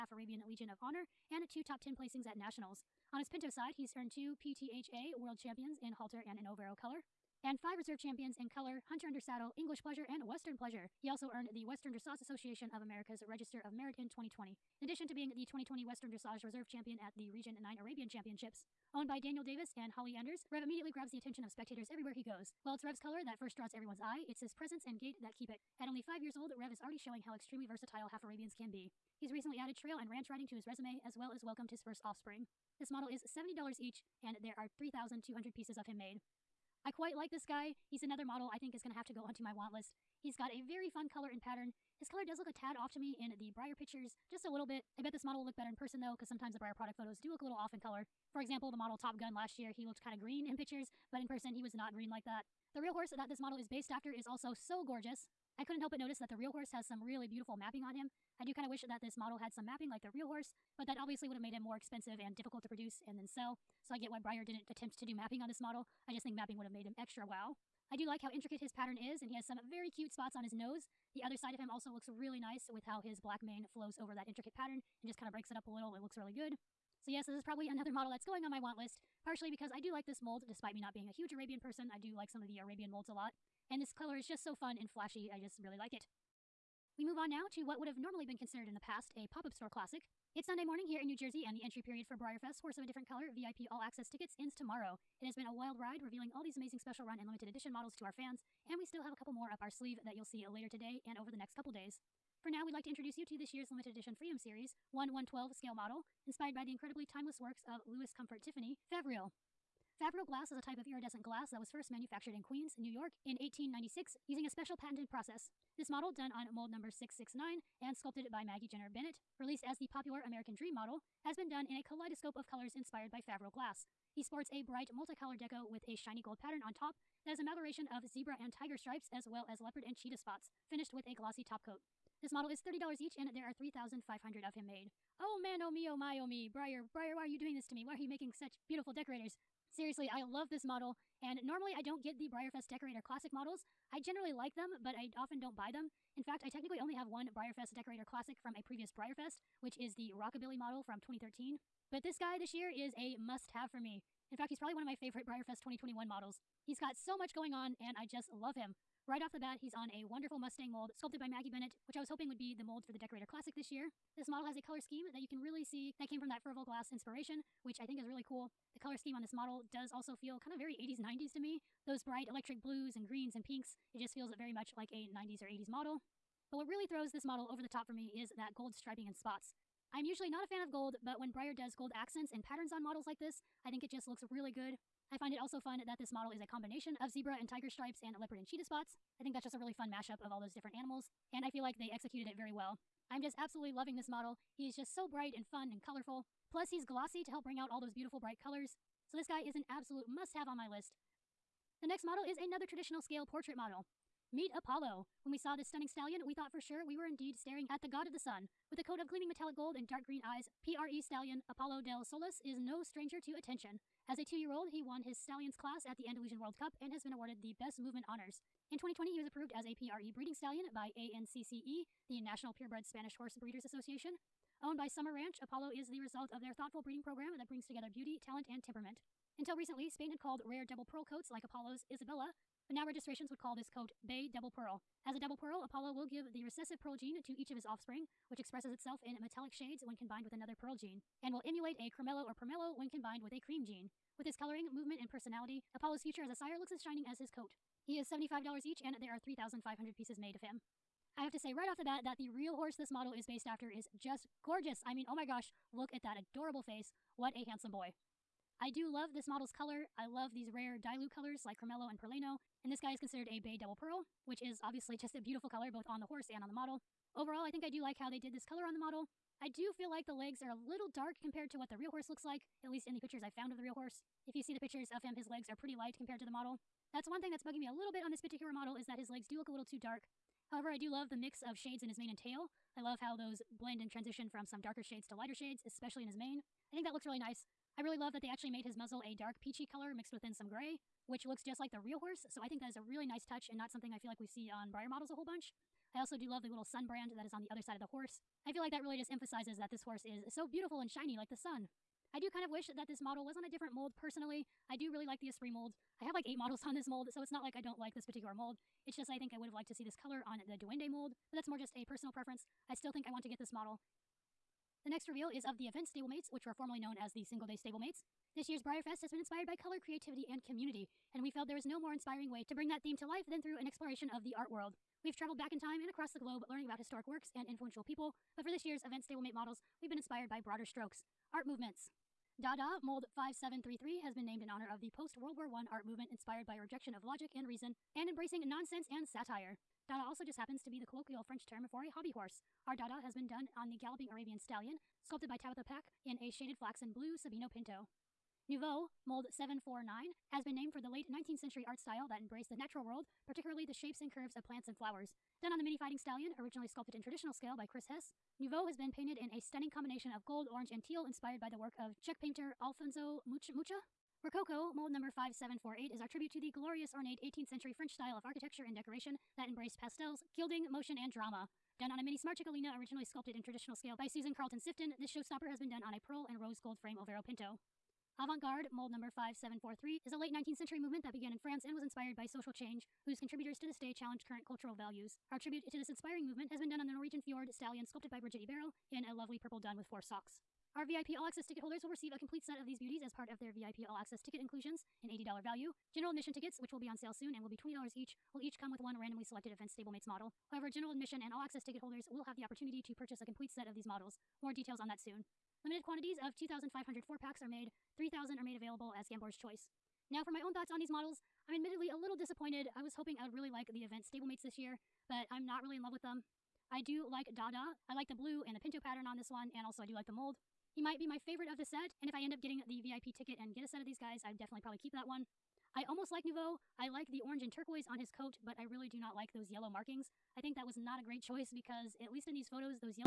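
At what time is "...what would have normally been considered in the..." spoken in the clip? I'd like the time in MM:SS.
01:27.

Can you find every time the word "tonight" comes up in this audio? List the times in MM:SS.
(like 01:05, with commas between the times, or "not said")
not said.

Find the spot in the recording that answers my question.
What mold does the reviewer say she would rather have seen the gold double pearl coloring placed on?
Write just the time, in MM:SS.
05:10.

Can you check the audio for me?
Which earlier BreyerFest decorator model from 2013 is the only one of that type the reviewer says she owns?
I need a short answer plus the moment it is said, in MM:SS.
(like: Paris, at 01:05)
Rockabilly, at 02:30.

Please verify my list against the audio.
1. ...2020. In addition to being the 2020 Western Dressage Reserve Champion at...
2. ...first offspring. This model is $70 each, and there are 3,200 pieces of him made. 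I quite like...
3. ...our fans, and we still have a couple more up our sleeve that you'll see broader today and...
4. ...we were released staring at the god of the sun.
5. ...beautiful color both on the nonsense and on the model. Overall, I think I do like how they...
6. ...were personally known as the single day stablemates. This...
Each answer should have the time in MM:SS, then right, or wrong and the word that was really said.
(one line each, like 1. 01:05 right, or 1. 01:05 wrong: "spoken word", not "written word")
1. 00:14 right
2. 00:31 right
3. 01:38 wrong: "later", not "broader"
4. 03:26 wrong: "indeed", not "released"
5. 04:25 wrong: "horse", not "nonsense"
6. 05:16 wrong: "formerly", not "personally".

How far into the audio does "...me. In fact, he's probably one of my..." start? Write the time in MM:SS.
02:33.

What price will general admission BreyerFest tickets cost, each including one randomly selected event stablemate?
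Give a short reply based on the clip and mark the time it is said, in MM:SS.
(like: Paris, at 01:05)
$20, at 06:37.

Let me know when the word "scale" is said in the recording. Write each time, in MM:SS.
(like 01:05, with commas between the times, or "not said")
01:45, 03:23, 05:57, 06:13.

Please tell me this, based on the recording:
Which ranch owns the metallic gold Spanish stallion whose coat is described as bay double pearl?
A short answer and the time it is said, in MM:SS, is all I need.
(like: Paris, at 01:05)
Summer Ranch, at 03:44.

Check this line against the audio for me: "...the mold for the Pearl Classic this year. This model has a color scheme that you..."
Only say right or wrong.
wrong.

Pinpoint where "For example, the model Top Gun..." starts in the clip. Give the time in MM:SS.
00:48.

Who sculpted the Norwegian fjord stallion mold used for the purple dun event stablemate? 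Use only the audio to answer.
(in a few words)
Brigitte Eberl.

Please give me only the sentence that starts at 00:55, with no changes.
I couldn't help but notice that the real horse has some really beautiful mapping on him.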